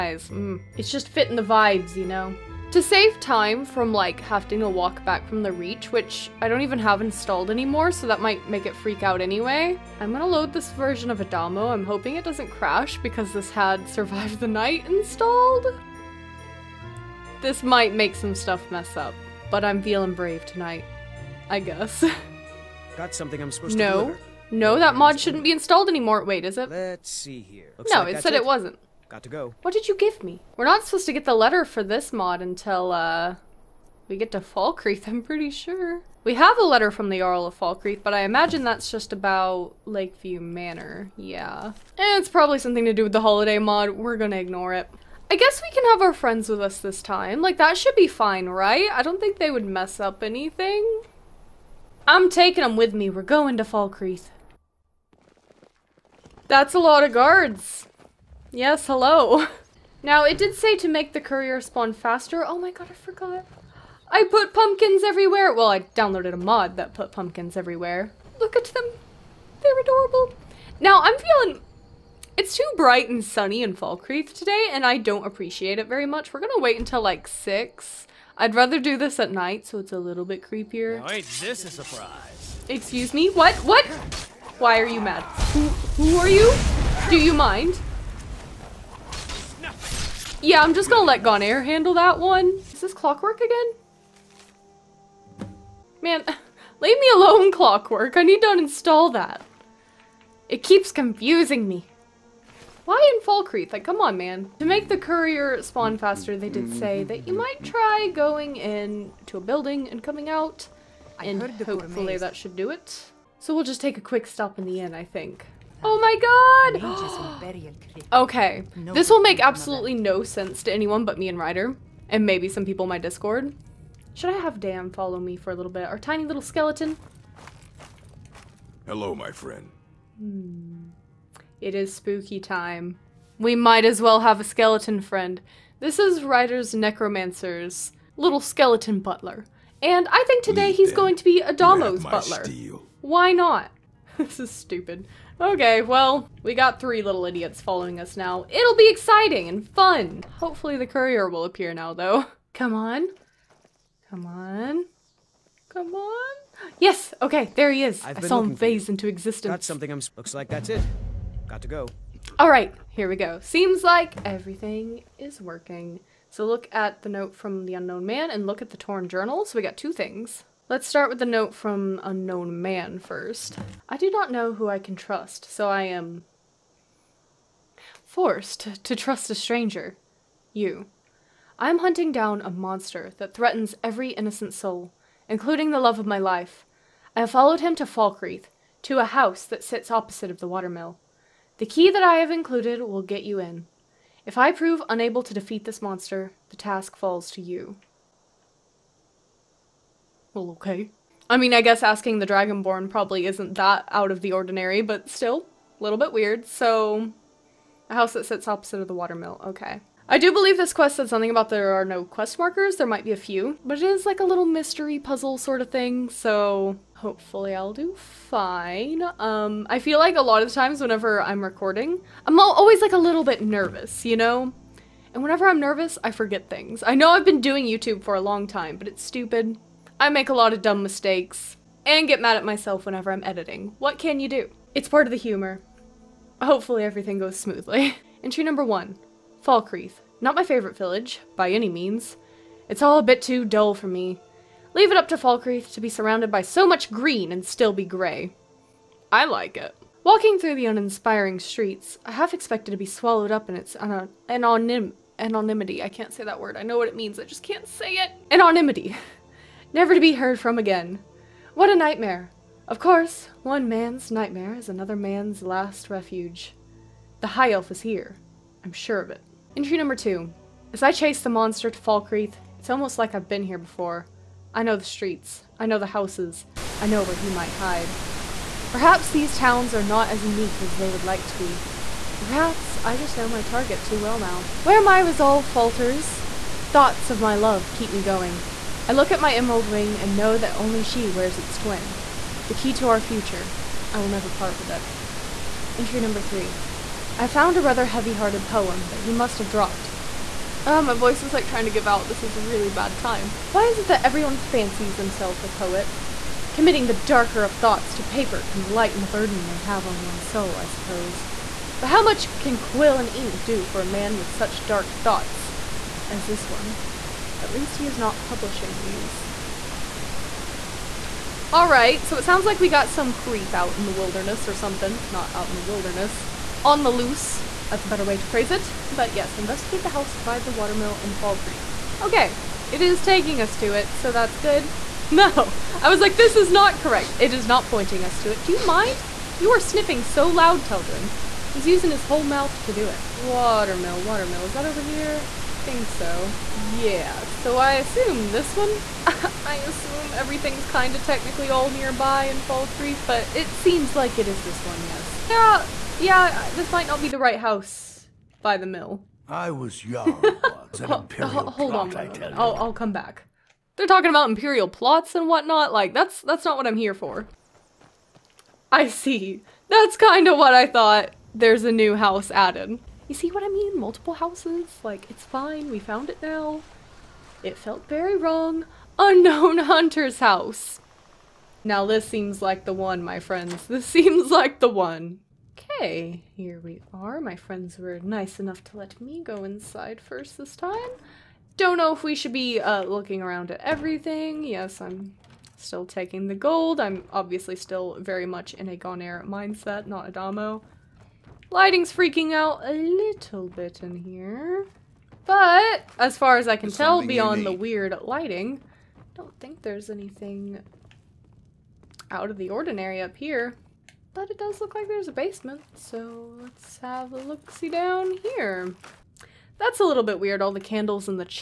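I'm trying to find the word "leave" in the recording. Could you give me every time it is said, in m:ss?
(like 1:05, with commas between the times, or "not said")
1:36, 4:04.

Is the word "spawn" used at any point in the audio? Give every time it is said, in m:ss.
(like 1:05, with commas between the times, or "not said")
1:01, 1:45.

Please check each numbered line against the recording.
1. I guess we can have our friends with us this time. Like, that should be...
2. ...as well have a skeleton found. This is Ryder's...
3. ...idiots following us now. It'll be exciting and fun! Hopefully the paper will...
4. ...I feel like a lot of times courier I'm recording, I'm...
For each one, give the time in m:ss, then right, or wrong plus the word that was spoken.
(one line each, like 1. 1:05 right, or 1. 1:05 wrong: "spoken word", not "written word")
1. 0:45 right
2. 2:13 wrong: "friend", not "found"
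3. 2:27 wrong: "courier", not "paper"
4. 3:39 wrong: "whenever", not "courier".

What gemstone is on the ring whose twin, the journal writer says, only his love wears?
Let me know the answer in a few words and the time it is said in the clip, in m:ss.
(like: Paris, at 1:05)
emerald, at 4:49.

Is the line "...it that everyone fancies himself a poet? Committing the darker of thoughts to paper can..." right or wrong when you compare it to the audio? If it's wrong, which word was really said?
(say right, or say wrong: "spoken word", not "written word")
right.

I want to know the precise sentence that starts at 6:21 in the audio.
Now this seems like the one, my friends.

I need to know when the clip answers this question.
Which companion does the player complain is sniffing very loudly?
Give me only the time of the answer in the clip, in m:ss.
5:40.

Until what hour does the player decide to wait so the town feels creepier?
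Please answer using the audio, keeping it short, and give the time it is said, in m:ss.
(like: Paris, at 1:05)
6, at 1:17.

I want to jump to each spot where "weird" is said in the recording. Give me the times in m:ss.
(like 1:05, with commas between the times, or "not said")
3:26, 6:47, 7:00.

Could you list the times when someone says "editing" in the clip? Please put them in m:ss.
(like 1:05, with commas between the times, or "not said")
3:53.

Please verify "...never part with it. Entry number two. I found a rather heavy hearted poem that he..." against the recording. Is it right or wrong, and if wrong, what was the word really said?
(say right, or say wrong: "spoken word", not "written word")
wrong: "three", not "two".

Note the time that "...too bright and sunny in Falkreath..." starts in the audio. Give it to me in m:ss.
1:12.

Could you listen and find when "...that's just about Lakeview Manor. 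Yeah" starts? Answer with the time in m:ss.
0:38.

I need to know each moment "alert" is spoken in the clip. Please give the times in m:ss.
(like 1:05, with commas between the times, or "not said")
not said.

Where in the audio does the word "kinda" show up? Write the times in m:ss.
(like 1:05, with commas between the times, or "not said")
5:50, 6:09.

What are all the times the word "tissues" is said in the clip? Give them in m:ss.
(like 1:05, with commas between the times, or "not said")
not said.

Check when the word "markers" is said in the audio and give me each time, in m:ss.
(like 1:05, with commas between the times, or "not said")
3:32.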